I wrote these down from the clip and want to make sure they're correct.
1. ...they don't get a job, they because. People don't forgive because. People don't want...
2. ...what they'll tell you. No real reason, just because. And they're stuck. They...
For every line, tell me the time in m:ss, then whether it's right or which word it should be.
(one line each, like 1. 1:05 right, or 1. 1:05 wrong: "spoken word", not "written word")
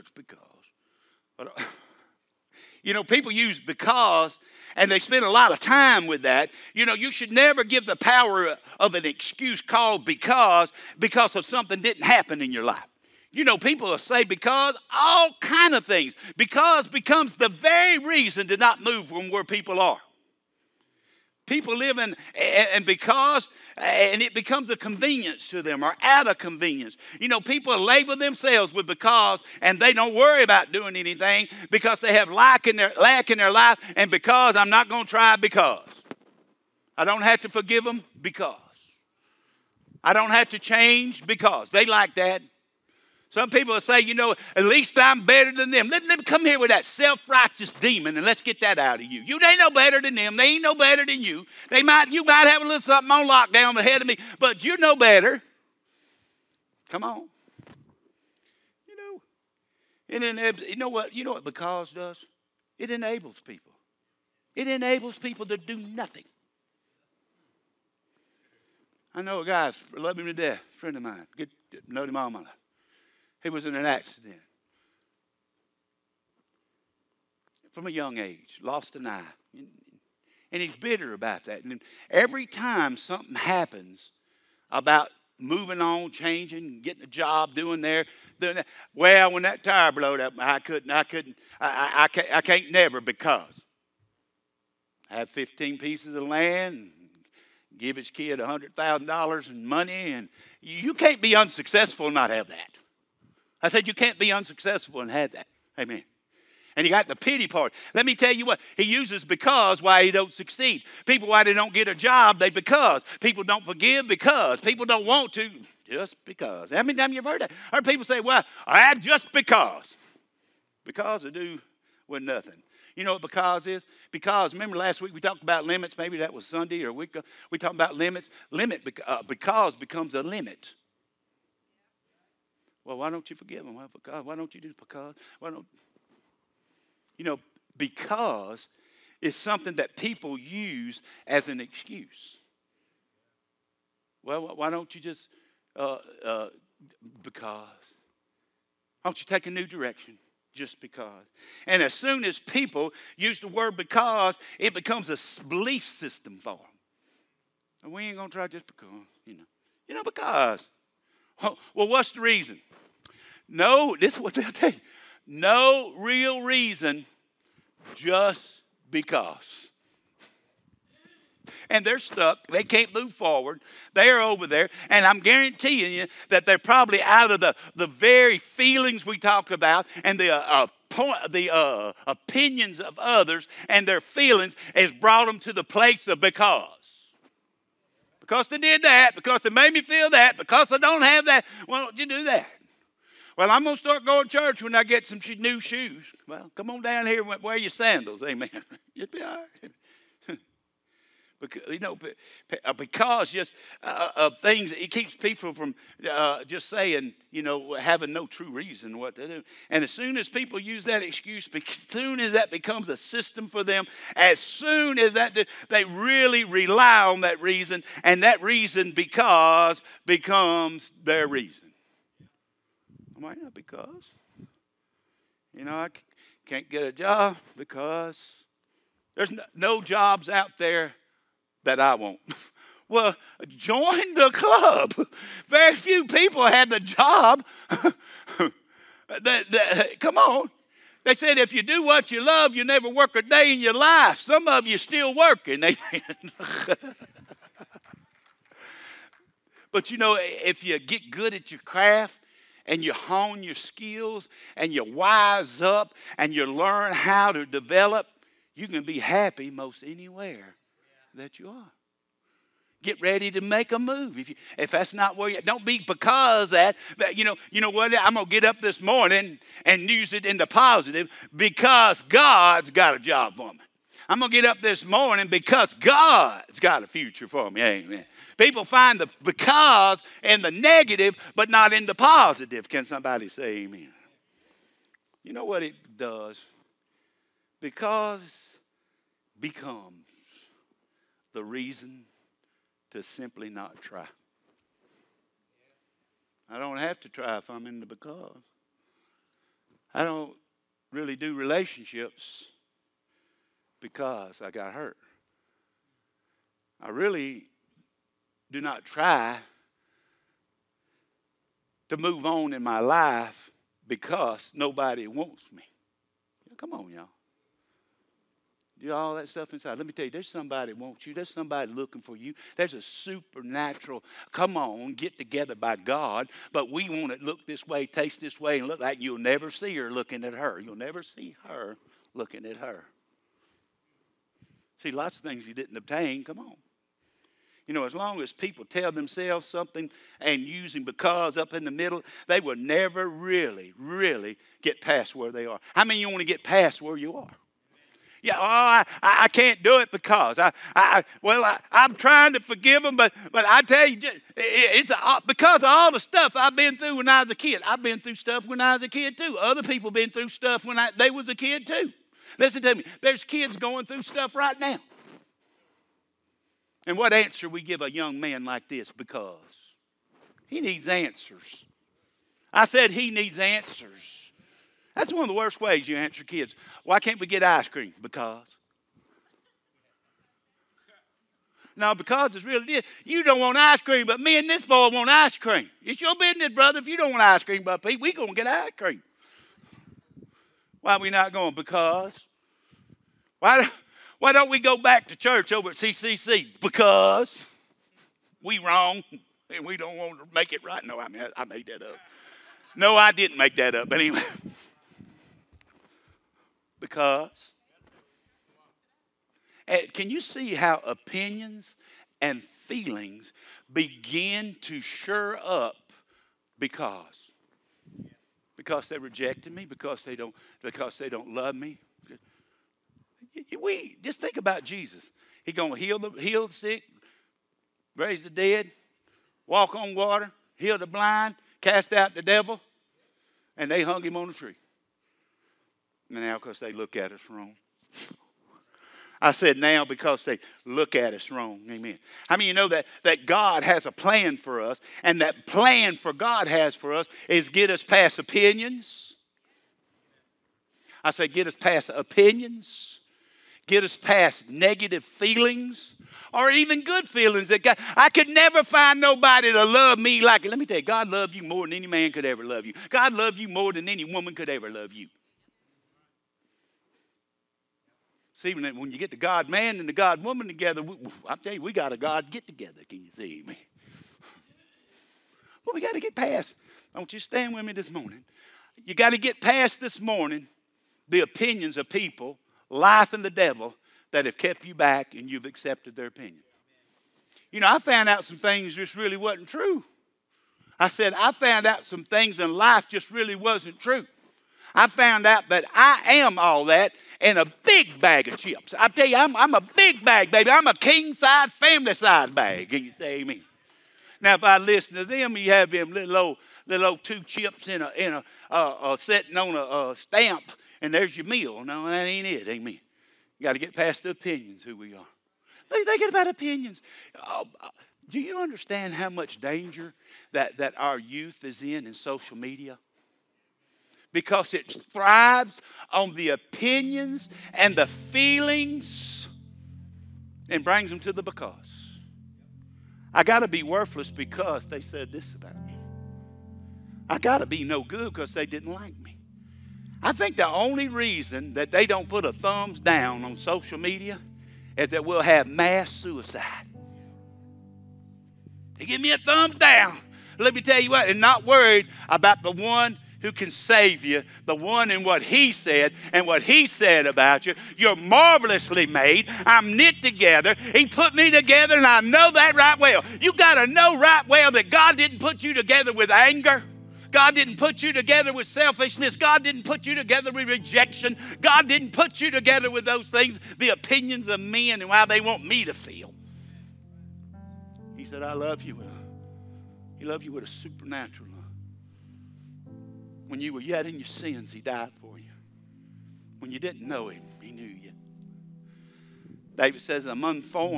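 1. 1:51 right
2. 2:44 right.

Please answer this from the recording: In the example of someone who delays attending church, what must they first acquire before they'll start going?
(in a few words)
new shoes.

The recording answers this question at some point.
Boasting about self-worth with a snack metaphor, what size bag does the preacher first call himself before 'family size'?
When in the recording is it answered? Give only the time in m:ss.
8:20.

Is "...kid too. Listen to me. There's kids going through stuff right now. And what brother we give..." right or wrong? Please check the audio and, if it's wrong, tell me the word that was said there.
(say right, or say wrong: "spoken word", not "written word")
wrong: "answer", not "brother".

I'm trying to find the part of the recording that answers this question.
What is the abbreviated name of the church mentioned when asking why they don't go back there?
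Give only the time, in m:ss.
6:35.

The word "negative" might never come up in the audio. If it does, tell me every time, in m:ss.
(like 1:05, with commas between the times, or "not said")
4:40, 7:34.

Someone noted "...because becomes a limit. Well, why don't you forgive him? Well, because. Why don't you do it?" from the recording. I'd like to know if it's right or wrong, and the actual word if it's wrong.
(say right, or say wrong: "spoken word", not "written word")
right.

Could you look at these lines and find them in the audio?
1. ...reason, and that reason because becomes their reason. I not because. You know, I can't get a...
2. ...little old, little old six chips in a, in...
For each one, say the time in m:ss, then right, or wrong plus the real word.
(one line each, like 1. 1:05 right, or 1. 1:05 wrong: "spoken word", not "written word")
1. 3:37 right
2. 8:25 wrong: "two", not "six".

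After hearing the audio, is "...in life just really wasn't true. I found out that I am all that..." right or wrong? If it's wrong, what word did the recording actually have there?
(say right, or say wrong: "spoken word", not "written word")
right.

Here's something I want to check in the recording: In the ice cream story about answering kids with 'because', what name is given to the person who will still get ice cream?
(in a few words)
Pete.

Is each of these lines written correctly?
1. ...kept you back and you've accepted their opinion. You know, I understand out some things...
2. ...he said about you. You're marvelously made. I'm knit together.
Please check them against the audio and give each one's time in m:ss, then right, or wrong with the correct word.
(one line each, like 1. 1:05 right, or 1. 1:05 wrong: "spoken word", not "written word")
1. 8:04 wrong: "found", not "understand"
2. 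9:16 right.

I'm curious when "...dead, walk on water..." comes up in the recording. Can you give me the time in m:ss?
7:08.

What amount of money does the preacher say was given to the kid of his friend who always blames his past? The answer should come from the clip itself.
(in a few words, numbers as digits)
$100,000.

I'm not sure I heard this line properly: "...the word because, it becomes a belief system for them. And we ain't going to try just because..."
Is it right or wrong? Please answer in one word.
right.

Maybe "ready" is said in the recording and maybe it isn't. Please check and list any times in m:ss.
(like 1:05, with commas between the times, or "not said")
4:22.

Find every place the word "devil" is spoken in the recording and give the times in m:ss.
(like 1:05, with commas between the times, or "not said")
7:12, 8:03.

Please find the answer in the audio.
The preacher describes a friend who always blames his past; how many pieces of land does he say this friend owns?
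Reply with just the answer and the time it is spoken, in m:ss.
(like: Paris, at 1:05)
15, at 1:35.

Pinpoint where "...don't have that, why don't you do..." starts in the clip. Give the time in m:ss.
3:10.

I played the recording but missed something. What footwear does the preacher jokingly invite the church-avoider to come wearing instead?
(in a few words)
sandals.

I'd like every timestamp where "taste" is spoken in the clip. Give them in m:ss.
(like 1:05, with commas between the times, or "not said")
5:27.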